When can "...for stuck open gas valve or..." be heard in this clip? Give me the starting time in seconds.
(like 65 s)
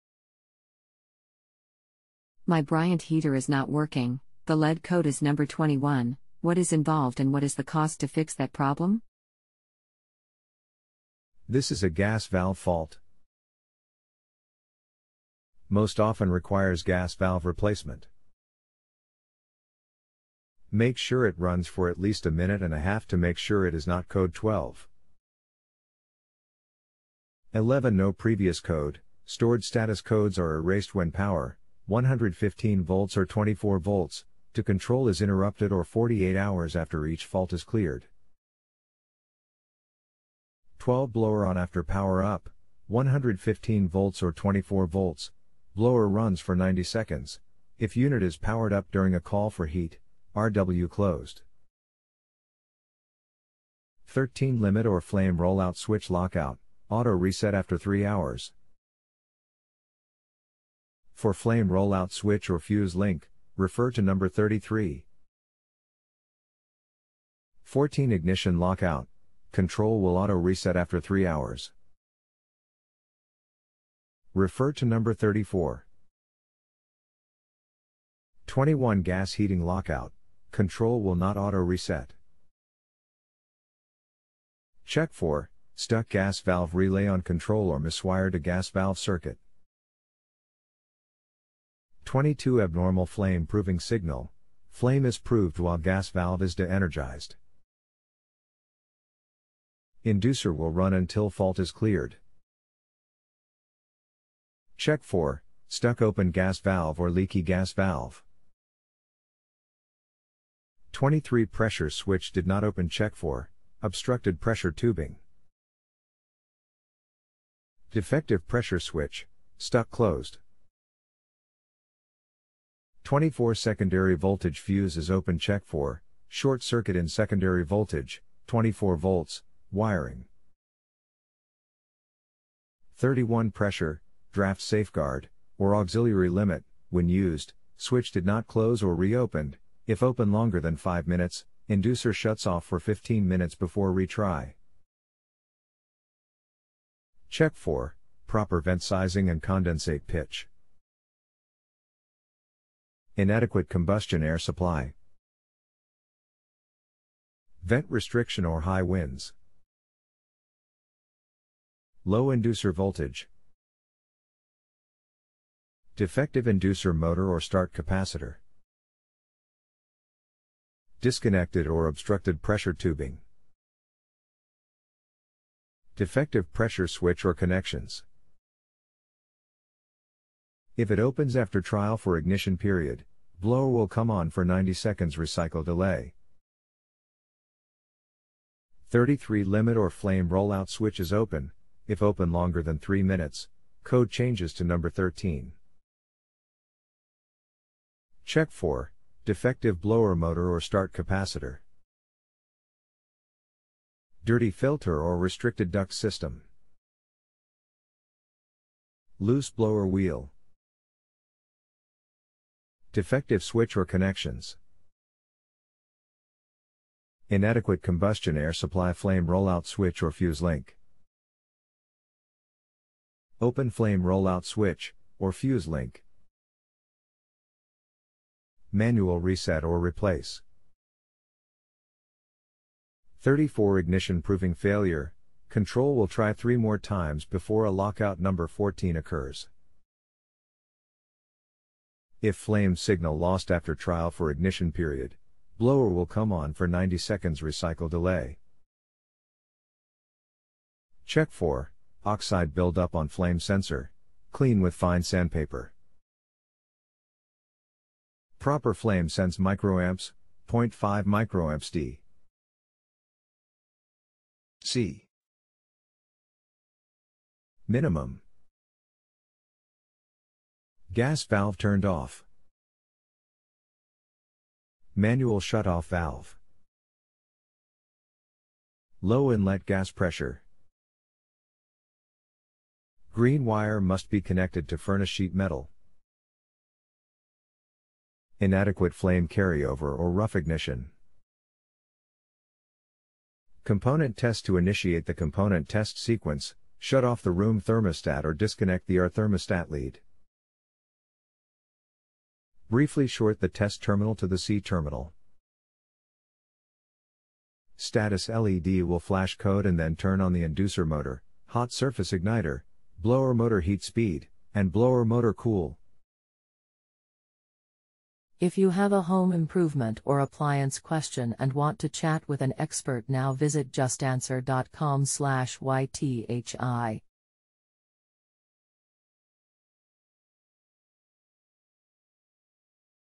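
105 s.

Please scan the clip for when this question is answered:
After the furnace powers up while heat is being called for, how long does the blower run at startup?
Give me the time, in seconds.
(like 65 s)
45 s.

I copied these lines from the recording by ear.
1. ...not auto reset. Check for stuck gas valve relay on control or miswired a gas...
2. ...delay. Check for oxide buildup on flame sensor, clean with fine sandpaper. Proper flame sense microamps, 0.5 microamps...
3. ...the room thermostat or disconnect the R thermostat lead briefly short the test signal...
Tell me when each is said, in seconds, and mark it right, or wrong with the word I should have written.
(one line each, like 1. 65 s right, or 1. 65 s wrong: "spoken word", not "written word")
1. 81 s right
2. 247 s right
3. 297 s wrong: "terminal", not "signal".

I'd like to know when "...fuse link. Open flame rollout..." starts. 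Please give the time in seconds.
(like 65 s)
220 s.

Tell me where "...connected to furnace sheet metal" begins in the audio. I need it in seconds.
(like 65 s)
284 s.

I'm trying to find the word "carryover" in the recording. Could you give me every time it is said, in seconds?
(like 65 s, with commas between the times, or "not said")
289 s.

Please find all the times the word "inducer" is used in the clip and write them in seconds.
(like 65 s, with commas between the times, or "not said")
100 s, 141 s, 162 s, 166 s, 310 s.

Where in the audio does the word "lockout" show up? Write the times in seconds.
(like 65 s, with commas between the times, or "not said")
56 s, 68 s, 79 s, 237 s.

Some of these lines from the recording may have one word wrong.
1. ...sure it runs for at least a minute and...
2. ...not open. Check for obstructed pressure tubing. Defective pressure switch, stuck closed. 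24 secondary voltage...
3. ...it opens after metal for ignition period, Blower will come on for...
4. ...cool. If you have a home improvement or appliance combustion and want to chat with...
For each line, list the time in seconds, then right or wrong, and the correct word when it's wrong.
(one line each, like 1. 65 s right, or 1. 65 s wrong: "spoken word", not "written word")
1. 20 s right
2. 112 s right
3. 180 s wrong: "trial", not "metal"
4. 315 s wrong: "question", not "combustion".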